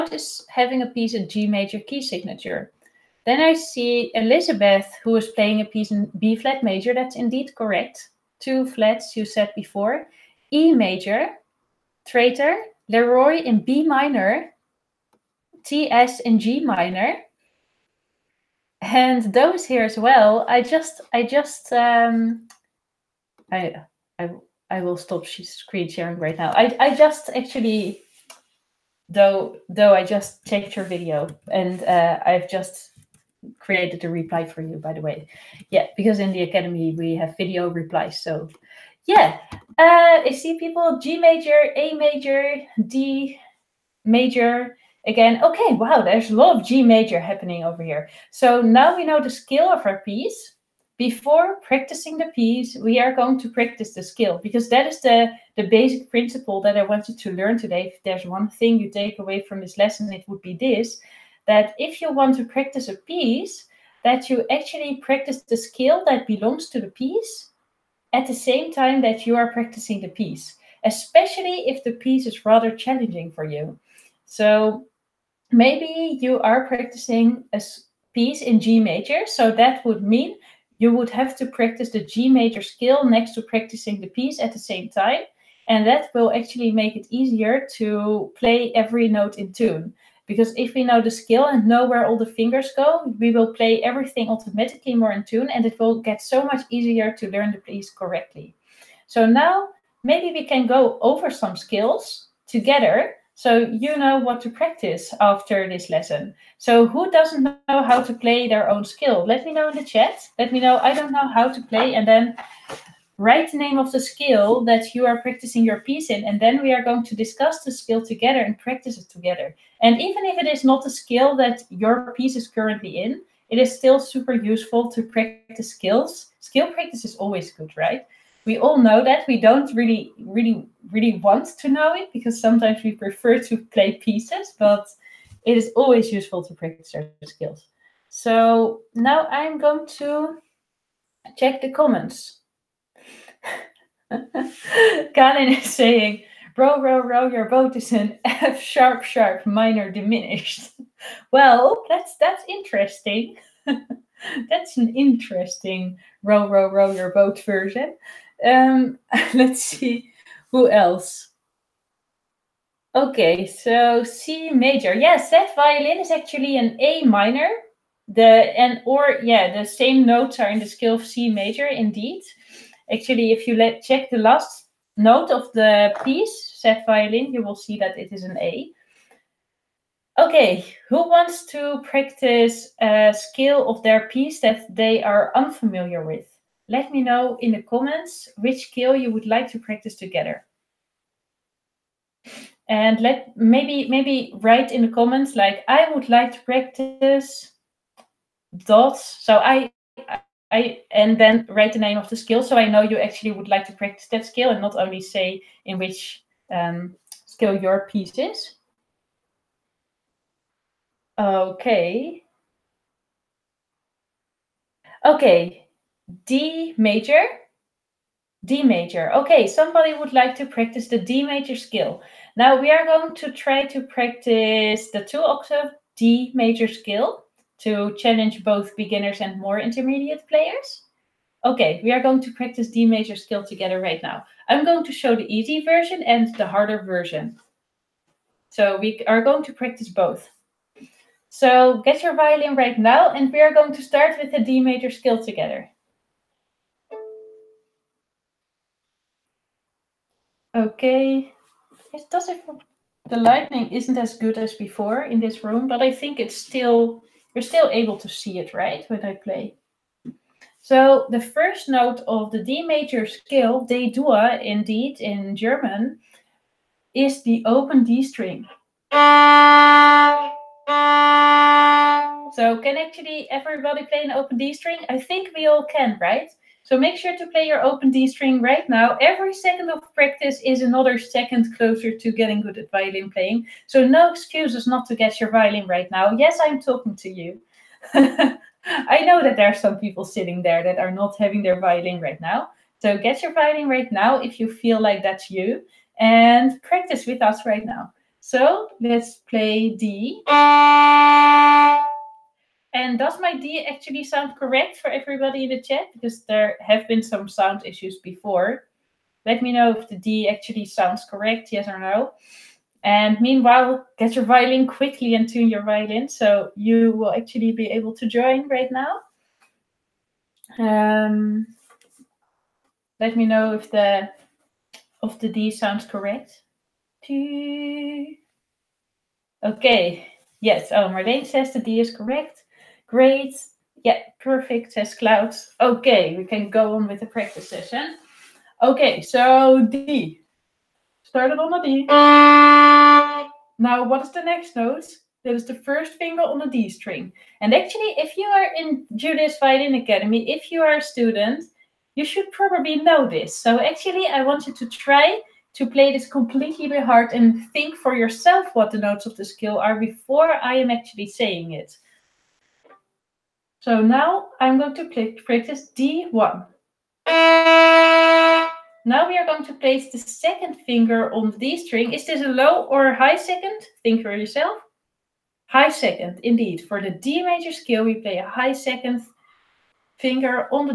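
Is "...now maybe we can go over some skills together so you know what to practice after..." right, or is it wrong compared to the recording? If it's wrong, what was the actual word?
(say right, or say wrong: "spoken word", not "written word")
right.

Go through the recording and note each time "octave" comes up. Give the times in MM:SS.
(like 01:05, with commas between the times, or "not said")
03:45.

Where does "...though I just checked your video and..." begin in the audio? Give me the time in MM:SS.
00:29.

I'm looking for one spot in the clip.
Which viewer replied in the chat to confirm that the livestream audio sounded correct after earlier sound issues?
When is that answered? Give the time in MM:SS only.
05:30.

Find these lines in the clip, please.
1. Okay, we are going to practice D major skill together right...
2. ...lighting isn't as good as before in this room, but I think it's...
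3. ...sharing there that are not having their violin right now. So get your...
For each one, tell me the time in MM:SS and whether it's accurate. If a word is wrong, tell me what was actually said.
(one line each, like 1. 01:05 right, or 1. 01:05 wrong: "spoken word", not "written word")
1. 03:51 right
2. 04:13 right
3. 04:50 wrong: "sitting", not "sharing".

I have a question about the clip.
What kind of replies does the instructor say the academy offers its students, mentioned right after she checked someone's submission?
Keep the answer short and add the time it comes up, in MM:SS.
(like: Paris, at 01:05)
video replies, at 00:37.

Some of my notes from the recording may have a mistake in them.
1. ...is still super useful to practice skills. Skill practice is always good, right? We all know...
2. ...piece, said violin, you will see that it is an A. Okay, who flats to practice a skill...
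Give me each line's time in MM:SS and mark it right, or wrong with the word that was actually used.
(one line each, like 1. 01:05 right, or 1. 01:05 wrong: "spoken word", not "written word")
1. 02:03 right
2. 02:56 wrong: "wants", not "flats".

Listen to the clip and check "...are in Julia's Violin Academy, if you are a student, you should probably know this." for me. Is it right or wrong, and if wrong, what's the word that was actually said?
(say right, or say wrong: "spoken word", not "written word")
right.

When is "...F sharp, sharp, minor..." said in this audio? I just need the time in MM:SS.
02:28.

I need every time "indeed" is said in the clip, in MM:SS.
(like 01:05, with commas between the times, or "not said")
00:07, 02:51, 04:24, 06:16.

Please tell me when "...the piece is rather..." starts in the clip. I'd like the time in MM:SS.
01:11.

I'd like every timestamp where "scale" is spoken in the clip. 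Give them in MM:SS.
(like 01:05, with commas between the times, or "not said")
00:49, 00:54, 01:05, 02:50, 04:23, 06:17.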